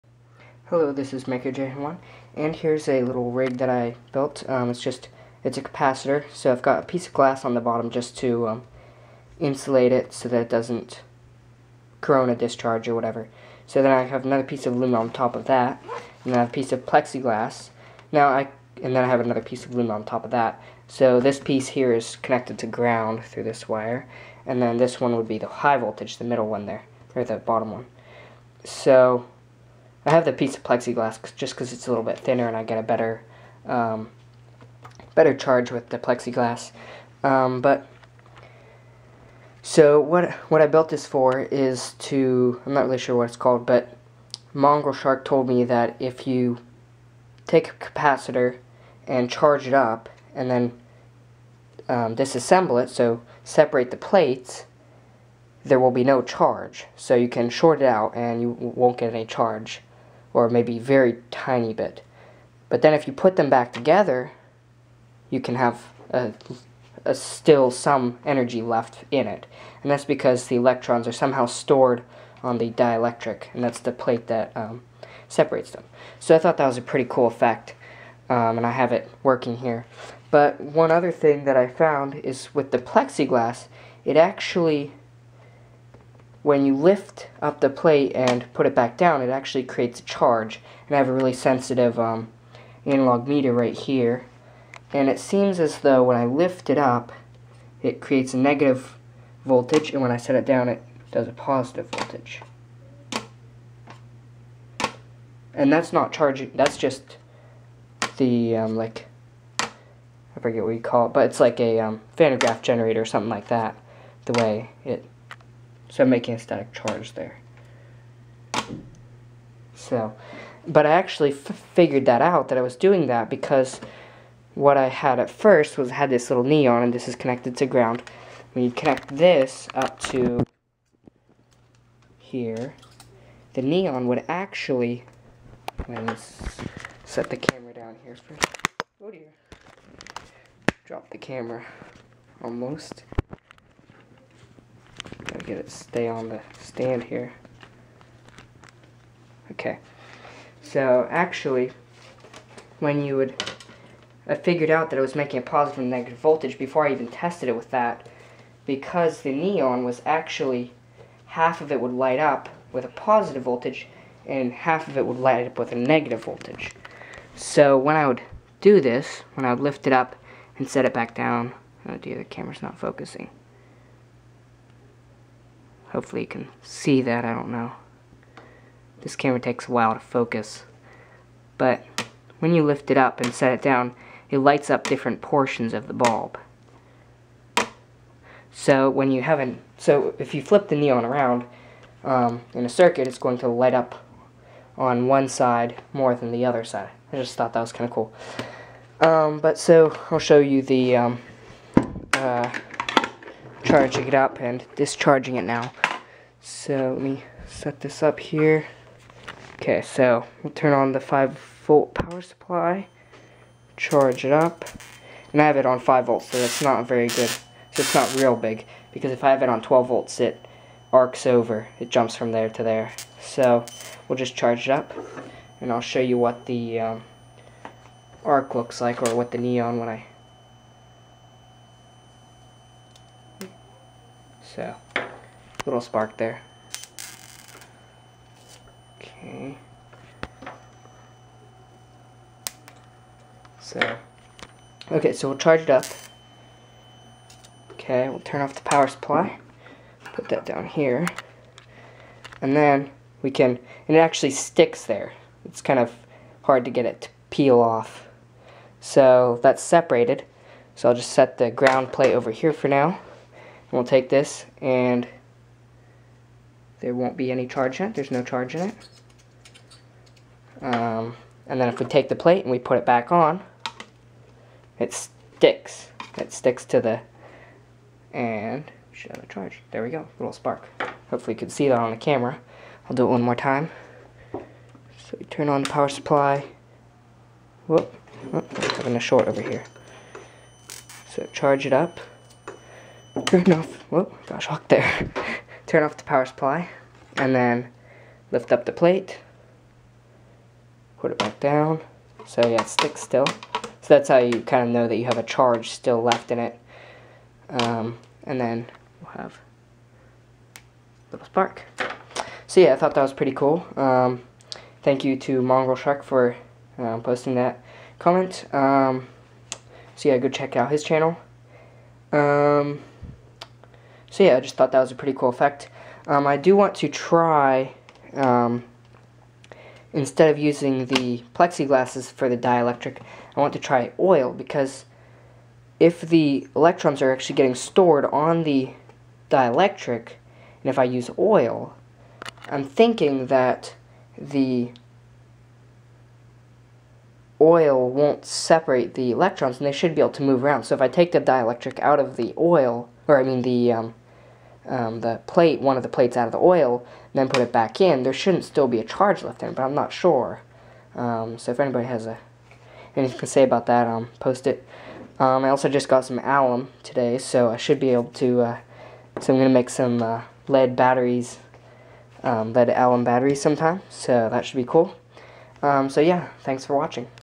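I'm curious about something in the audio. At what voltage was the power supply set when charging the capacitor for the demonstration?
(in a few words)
5 volts.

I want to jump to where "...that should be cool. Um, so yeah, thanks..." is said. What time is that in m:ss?
6:14.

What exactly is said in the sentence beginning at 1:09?
And that's because the electrons are somehow stored on the dielectric, and that's the plate that um, separates them.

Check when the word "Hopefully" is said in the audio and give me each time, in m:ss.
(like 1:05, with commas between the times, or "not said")
2:55, 4:41.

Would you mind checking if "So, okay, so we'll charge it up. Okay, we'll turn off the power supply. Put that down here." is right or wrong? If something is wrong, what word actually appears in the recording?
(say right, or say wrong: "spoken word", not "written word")
right.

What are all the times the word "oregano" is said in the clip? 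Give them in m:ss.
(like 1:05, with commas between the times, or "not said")
not said.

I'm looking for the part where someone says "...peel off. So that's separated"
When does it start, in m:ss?
4:17.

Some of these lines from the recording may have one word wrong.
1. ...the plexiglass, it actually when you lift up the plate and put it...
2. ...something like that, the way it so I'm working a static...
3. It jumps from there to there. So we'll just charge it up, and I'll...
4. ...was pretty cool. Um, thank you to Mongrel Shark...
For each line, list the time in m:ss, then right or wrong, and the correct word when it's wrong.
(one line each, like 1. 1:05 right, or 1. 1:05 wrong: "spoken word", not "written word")
1. 1:22 right
2. 1:53 wrong: "making", not "working"
3. 3:41 right
4. 5:13 right.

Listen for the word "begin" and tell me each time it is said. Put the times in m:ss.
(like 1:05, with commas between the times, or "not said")
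not said.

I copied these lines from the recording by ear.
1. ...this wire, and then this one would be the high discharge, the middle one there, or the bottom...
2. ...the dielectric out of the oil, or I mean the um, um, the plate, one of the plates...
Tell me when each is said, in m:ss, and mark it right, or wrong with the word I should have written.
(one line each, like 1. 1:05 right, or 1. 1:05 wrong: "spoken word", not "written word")
1. 0:23 wrong: "voltage", not "discharge"
2. 5:51 right.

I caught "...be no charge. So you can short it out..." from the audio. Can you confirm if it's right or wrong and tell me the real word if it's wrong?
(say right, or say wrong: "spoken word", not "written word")
right.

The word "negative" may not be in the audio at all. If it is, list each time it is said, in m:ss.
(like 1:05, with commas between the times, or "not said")
1:38, 2:35, 2:45.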